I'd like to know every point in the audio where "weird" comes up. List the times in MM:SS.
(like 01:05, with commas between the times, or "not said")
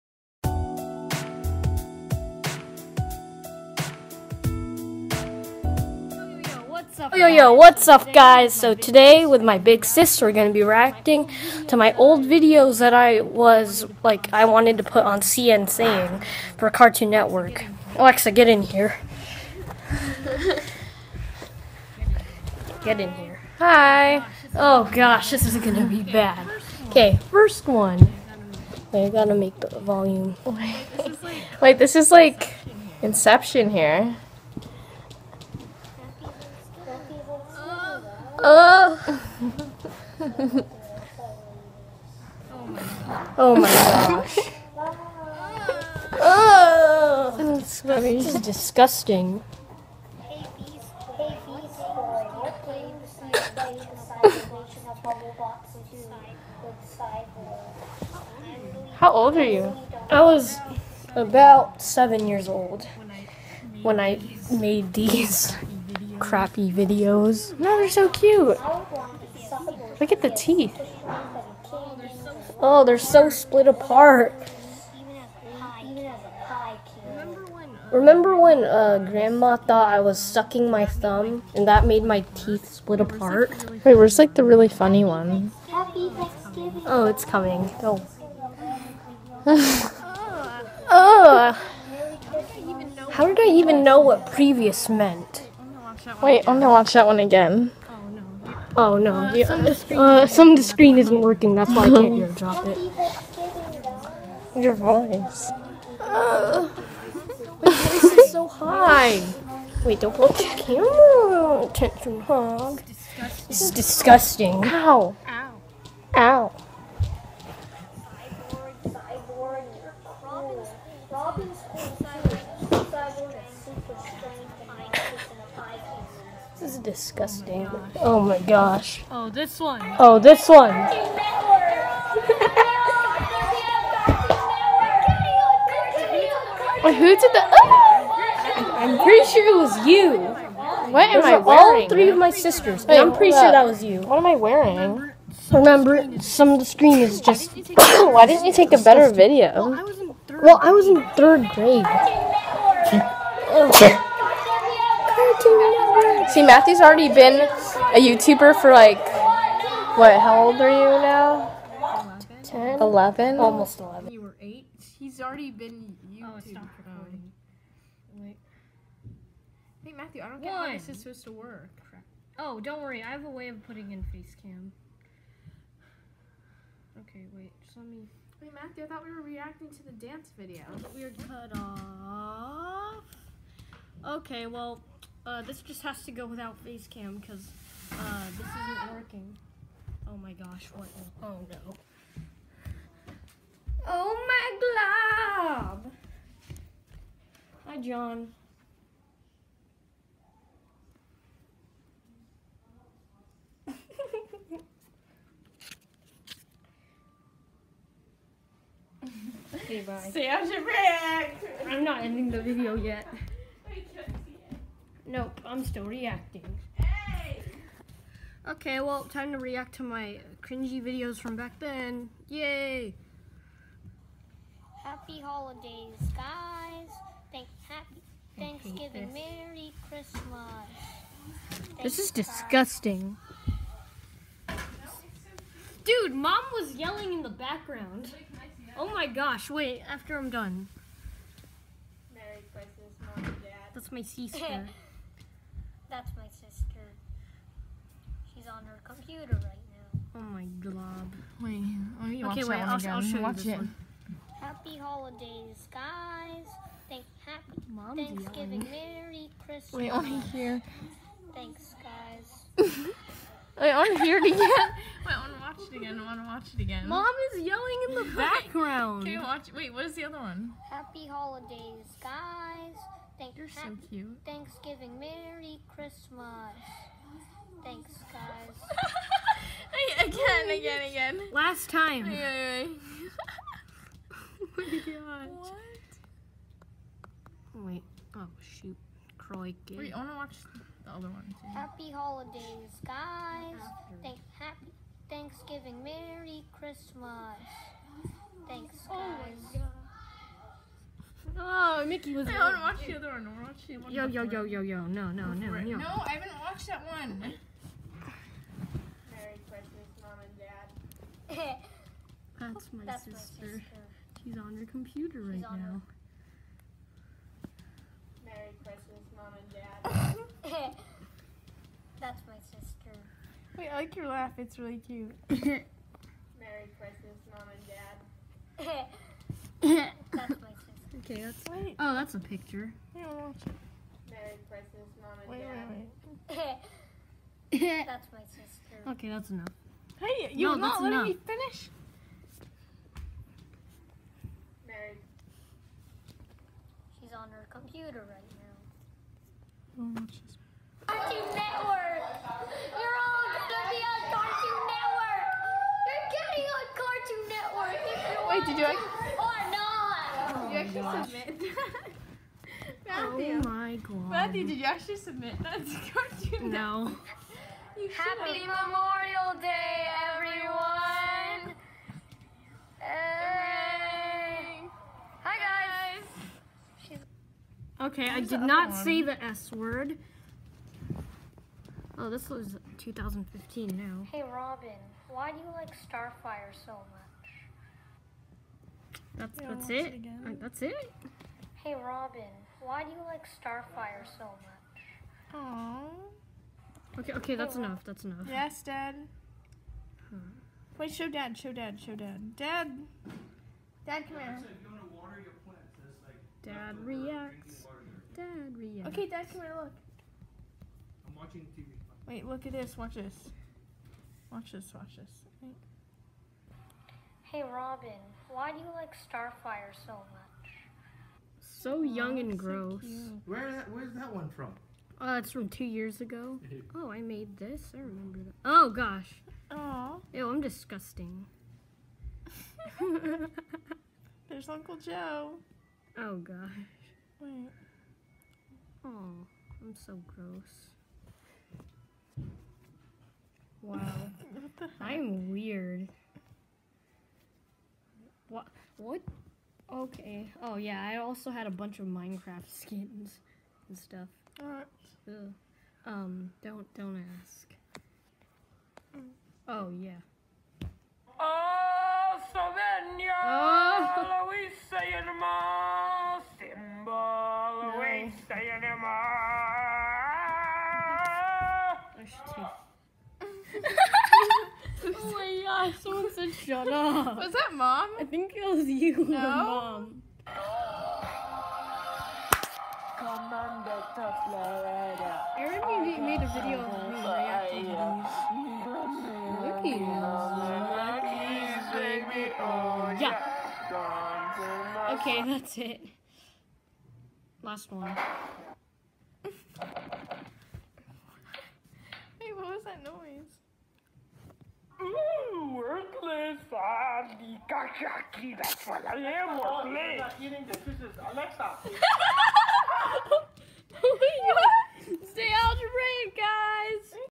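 07:25.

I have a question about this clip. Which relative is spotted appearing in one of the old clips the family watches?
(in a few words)
Uncle Joe.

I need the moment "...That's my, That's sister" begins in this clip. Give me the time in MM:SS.
05:12.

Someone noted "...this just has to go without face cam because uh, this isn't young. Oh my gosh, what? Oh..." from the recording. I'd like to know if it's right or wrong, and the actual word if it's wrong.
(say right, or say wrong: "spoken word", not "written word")
wrong: "working", not "young".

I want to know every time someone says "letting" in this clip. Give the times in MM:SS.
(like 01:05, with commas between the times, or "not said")
05:40.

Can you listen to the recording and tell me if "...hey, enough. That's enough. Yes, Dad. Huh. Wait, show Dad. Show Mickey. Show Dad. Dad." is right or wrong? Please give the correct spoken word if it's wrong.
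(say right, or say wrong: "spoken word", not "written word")
wrong: "Dad", not "Mickey".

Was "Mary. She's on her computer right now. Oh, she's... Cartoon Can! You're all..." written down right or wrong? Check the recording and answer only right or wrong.
wrong.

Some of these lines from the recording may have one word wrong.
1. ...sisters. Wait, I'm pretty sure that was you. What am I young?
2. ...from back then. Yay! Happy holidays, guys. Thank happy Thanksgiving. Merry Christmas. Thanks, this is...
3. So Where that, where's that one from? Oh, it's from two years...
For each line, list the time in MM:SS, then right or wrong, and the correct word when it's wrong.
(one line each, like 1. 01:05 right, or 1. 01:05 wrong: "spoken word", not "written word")
1. 02:22 wrong: "wearing", not "young"
2. 03:41 right
3. 07:02 right.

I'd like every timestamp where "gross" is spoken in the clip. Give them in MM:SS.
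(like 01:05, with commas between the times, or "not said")
07:02, 07:20.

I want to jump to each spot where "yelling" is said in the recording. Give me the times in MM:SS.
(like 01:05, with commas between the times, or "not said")
03:56, 04:18, 04:27.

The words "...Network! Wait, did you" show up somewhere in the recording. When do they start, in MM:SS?
05:57.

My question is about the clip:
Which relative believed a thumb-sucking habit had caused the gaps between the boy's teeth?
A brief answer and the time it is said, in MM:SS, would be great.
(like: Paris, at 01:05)
Grandma, at 01:19.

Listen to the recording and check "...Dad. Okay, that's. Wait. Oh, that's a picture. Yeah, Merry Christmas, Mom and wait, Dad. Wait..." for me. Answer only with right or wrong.
right.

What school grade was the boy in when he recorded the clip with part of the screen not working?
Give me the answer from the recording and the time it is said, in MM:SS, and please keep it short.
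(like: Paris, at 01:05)
third grade, at 02:31.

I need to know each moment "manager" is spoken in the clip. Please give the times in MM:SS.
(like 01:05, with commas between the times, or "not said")
not said.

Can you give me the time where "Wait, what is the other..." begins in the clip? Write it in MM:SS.
04:29.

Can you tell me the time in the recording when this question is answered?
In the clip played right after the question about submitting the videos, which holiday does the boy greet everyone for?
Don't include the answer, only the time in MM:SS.
06:08.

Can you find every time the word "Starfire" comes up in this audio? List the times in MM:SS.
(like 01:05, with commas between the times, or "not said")
06:25, 06:33, 06:58.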